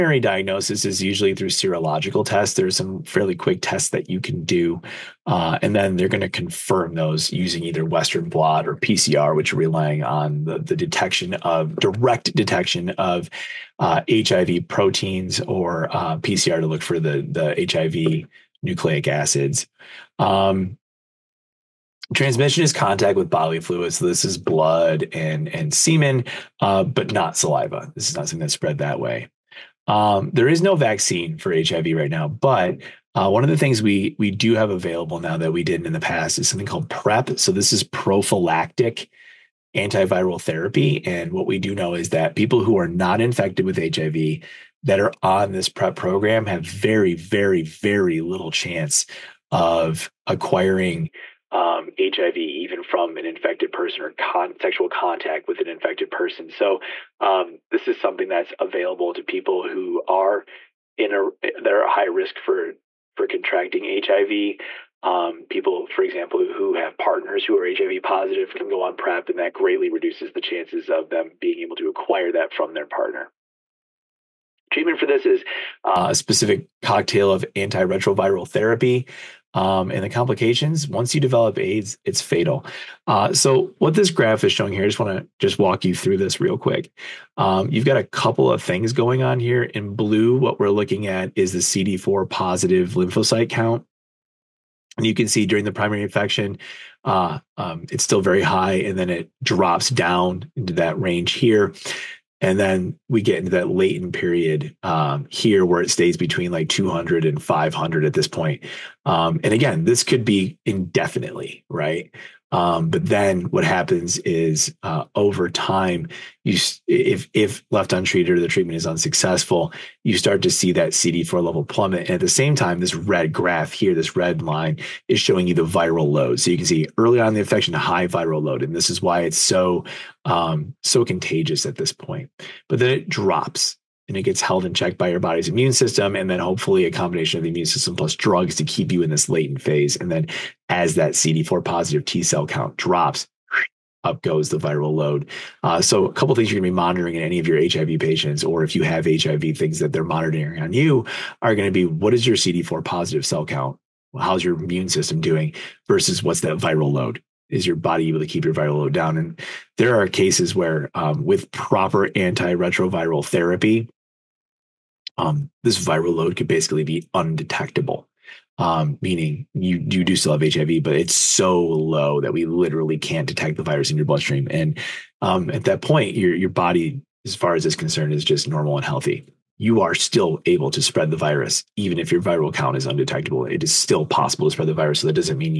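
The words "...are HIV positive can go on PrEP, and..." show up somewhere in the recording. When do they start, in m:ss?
1:07.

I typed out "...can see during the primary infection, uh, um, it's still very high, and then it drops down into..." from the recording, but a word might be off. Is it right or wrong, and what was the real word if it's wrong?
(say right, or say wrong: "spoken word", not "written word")
right.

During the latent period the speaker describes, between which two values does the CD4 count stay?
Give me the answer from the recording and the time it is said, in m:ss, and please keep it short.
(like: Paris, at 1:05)
200 to 500, at 1:46.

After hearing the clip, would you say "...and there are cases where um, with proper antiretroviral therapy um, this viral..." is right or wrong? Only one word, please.
right.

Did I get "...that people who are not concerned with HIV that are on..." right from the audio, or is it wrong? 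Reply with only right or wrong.
wrong.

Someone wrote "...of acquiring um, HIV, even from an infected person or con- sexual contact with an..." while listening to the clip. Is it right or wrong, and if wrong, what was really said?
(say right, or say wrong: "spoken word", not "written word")
right.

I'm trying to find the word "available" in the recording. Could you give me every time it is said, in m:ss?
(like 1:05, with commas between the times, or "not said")
0:34, 0:58.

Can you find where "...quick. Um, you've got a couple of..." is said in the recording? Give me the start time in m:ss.
1:26.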